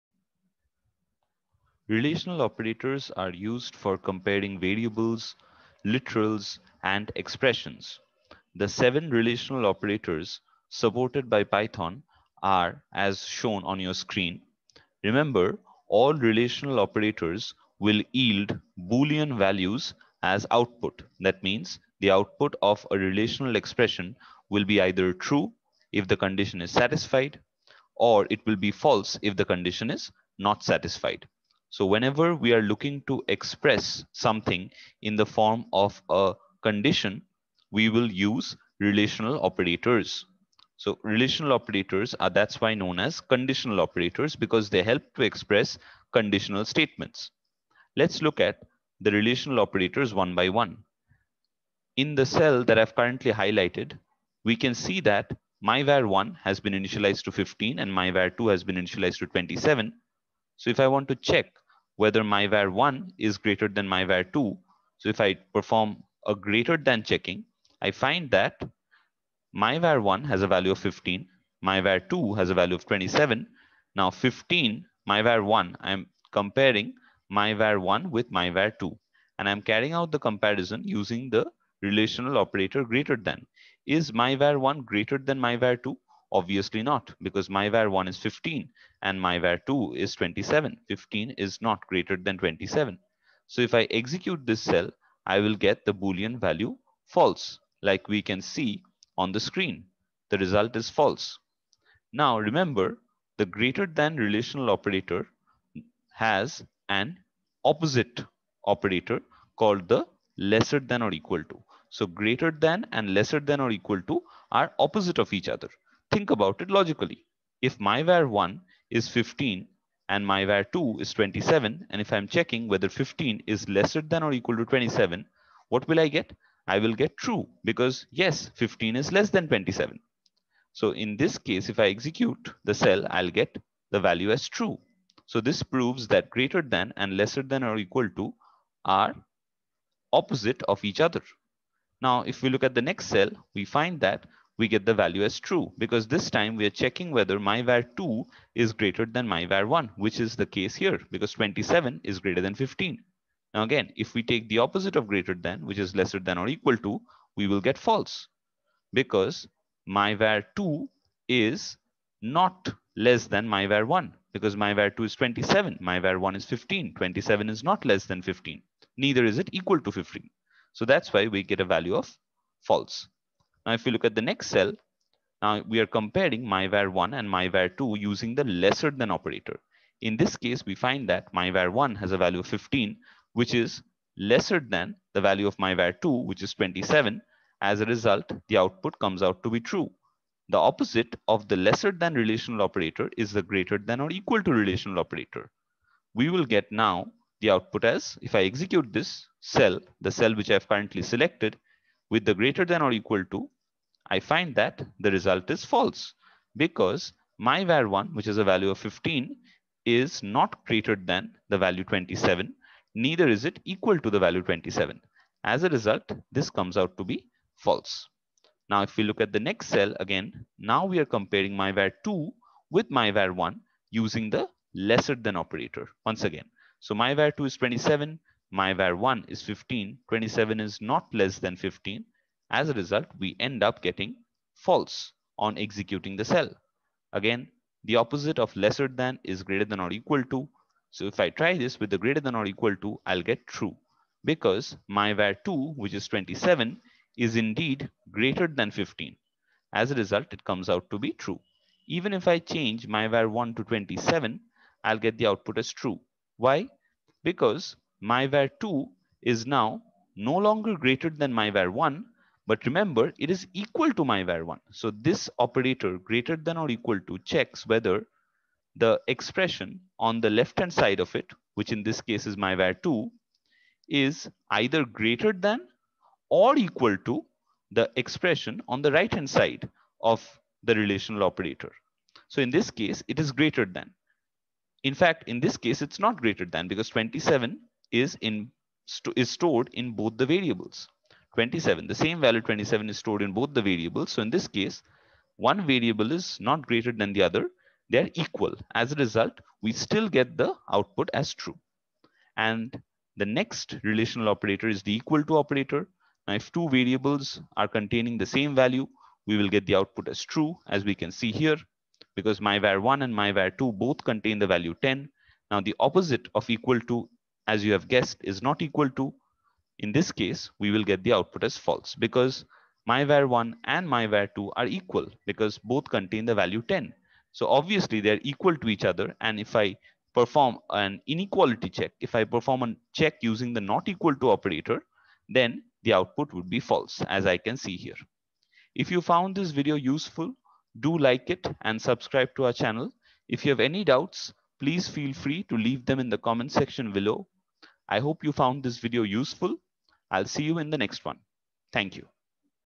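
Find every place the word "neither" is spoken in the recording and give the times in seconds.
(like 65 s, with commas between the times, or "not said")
168 s, 212 s.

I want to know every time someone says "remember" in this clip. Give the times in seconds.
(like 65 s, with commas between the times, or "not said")
15 s, 102 s, 262 s.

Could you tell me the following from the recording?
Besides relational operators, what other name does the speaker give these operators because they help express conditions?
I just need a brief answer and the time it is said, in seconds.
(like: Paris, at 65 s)
conditional operators, at 43 s.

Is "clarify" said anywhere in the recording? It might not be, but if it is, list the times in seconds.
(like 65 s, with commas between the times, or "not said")
not said.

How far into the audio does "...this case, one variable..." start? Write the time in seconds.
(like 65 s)
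294 s.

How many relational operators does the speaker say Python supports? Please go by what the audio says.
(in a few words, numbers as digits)
7.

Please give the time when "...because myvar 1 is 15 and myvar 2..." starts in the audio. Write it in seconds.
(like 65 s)
87 s.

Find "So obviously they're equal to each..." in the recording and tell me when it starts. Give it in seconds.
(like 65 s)
327 s.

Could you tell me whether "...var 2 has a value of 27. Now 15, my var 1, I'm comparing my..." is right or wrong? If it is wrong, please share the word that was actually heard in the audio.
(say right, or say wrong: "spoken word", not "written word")
right.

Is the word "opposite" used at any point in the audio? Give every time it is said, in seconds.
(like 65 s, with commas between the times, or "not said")
107 s, 114 s, 140 s, 154 s, 190 s, 237 s, 315 s.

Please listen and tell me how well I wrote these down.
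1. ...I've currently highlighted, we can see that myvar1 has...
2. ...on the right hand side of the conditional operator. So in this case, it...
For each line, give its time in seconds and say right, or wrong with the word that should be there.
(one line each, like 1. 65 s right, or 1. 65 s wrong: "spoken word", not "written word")
1. 52 s right
2. 278 s wrong: "relational", not "conditional".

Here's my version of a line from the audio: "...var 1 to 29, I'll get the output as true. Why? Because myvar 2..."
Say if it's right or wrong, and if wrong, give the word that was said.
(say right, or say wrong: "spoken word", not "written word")
wrong: "27", not "29".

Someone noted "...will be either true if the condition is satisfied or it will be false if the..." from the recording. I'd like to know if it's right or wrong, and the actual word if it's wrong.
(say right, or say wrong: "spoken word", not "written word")
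right.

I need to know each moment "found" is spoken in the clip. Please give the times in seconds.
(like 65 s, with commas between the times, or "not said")
339 s, 348 s.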